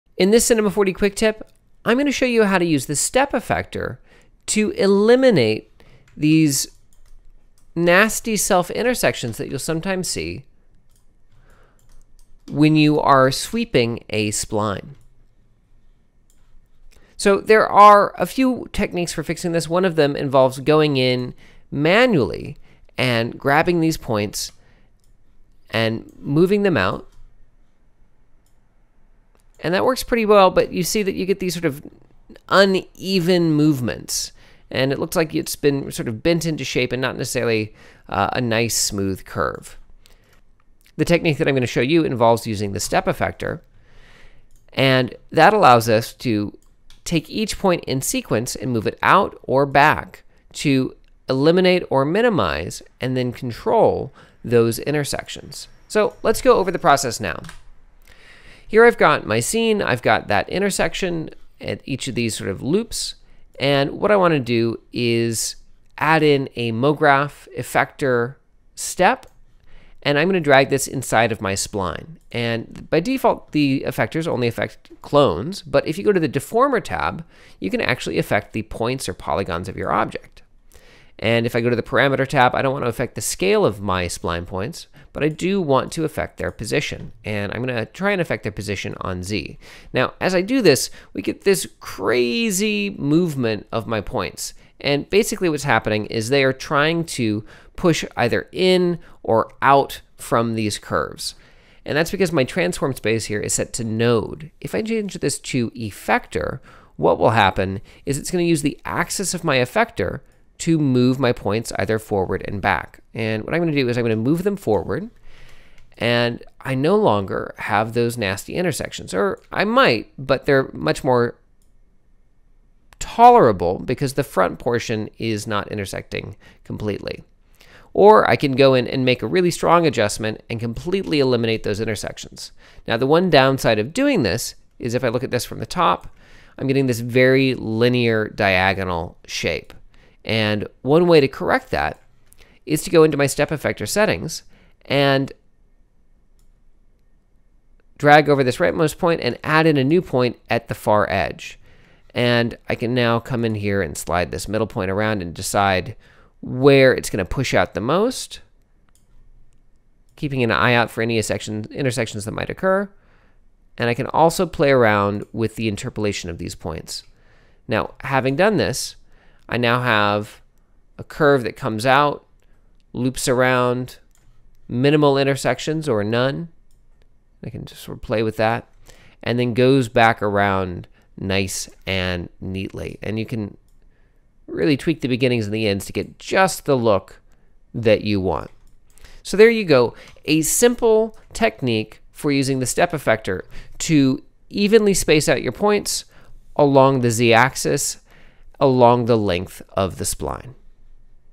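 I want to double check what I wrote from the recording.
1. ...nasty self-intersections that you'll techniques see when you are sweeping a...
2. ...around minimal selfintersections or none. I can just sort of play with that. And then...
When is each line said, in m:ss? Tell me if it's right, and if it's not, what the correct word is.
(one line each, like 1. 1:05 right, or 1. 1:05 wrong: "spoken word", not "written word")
1. 0:07 wrong: "sometimes", not "techniques"
2. 2:53 wrong: "intersections", not "selfintersections".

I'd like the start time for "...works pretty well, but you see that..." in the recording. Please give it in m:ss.
0:29.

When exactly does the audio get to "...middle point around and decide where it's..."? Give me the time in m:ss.
2:34.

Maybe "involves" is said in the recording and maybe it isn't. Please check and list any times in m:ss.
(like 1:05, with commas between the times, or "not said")
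0:20, 0:42.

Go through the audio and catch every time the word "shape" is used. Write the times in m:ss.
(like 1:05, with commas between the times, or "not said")
0:36, 2:19.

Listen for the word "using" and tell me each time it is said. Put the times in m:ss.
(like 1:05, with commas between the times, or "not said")
0:42, 3:12.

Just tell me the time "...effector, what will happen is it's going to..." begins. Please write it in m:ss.
1:45.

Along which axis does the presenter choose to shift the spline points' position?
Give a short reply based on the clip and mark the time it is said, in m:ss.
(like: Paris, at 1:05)
Z, at 1:29.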